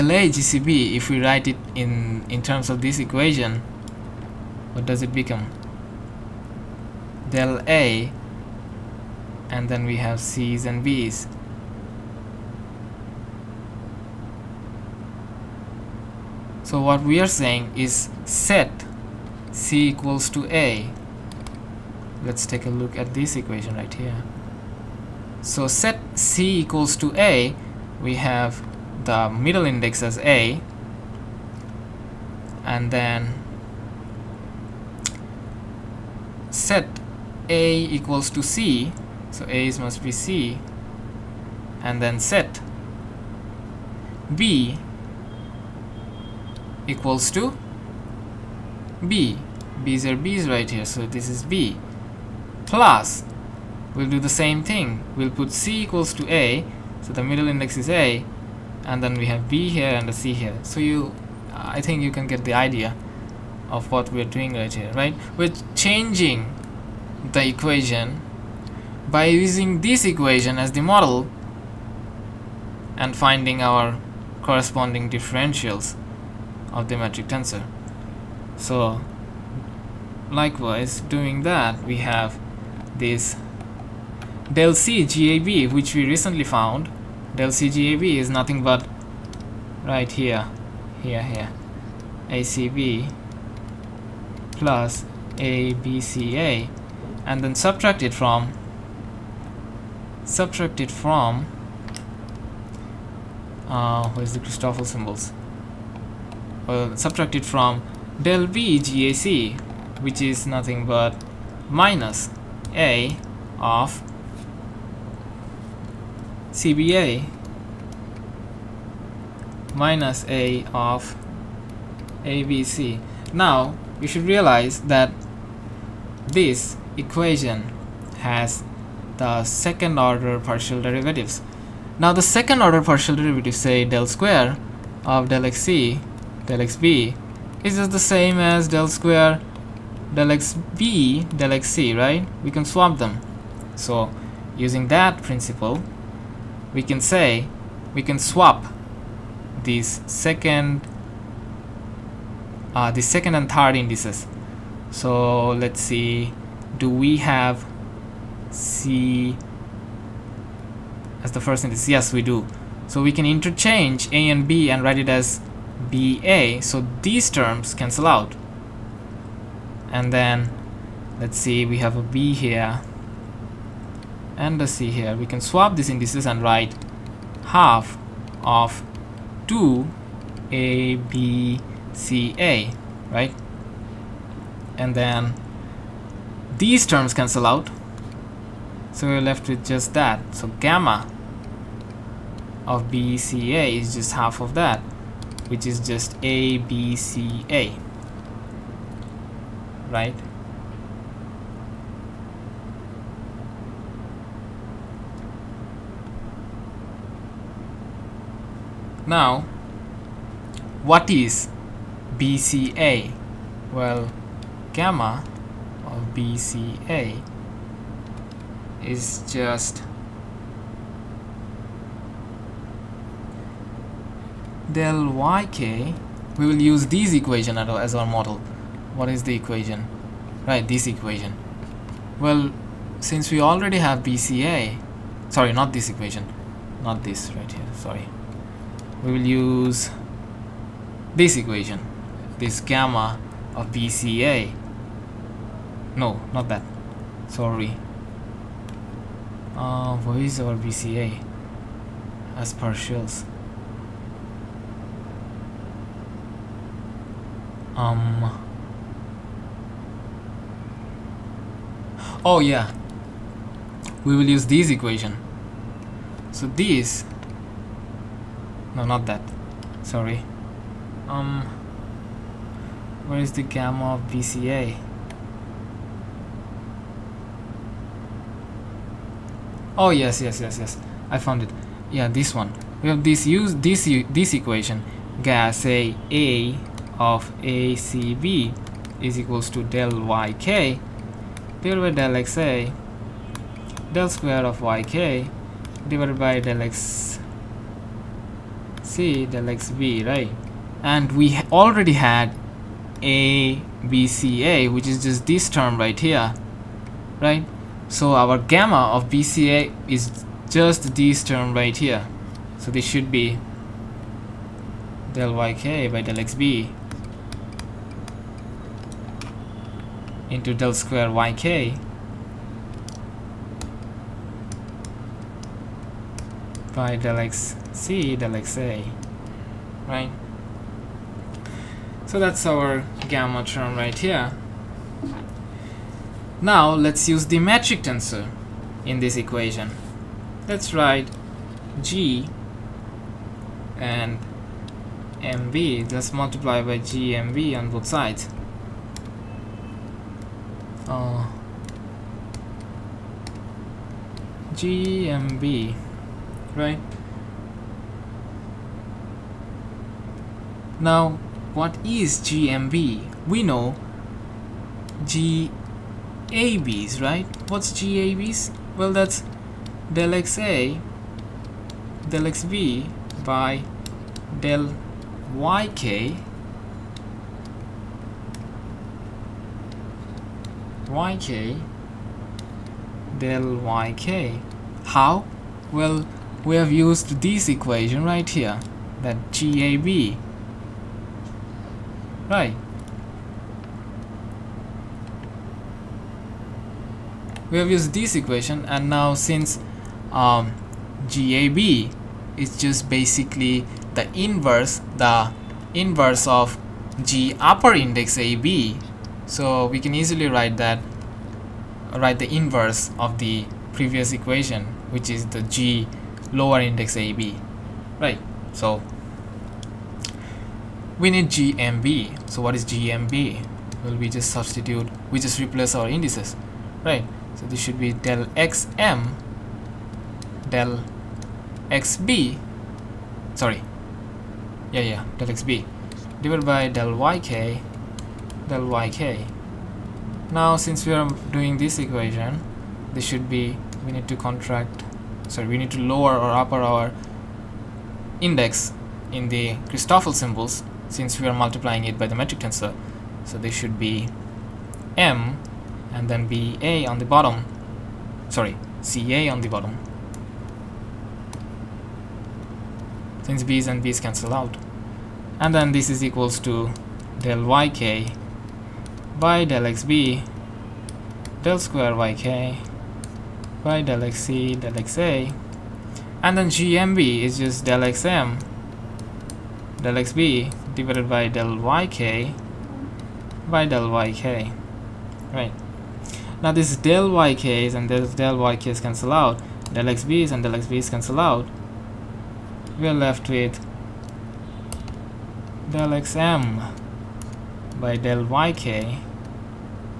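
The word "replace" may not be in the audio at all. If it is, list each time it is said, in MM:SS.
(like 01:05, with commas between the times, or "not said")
07:05.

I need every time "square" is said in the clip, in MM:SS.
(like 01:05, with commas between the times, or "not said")
02:14, 02:18, 04:54, 05:20, 07:51.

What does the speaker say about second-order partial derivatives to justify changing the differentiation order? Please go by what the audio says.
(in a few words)
we can swap them.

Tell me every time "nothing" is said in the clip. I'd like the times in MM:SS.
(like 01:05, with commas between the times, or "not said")
01:28, 01:50.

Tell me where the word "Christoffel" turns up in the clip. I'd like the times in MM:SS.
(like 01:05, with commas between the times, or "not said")
01:44, 07:29.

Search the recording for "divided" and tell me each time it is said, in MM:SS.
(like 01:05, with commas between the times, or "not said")
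04:51, 04:55, 07:16, 08:00.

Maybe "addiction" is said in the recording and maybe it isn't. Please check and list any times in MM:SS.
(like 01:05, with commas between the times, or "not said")
not said.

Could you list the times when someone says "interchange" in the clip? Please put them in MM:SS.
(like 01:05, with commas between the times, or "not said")
02:43.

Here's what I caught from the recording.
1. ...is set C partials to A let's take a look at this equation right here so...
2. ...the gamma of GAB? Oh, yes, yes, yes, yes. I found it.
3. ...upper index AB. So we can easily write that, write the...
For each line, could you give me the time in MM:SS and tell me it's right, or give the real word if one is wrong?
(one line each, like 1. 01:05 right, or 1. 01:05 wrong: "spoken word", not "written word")
1. 00:17 wrong: "equals", not "partials"
2. 04:33 wrong: "BCA", not "GAB"
3. 06:47 right.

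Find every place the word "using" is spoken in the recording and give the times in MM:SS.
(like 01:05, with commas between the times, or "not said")
01:09, 02:24.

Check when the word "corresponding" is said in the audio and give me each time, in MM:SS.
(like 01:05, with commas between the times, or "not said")
01:14.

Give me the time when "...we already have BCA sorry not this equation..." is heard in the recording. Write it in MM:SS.
03:53.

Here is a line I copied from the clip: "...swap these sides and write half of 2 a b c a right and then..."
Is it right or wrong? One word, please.
wrong.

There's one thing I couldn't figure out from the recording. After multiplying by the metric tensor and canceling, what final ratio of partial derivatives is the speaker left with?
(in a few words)
del xm by del yk.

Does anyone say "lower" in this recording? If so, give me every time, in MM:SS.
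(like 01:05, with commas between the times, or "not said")
06:56, 07:25.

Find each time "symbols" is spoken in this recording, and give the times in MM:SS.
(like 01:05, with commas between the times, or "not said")
01:44, 07:30.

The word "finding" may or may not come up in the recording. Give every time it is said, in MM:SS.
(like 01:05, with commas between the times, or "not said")
01:13.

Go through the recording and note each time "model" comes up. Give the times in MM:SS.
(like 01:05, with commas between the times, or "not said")
01:10, 03:48.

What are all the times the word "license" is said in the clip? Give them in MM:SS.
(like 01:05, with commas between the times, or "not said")
not said.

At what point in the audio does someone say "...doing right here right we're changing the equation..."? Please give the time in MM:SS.
01:04.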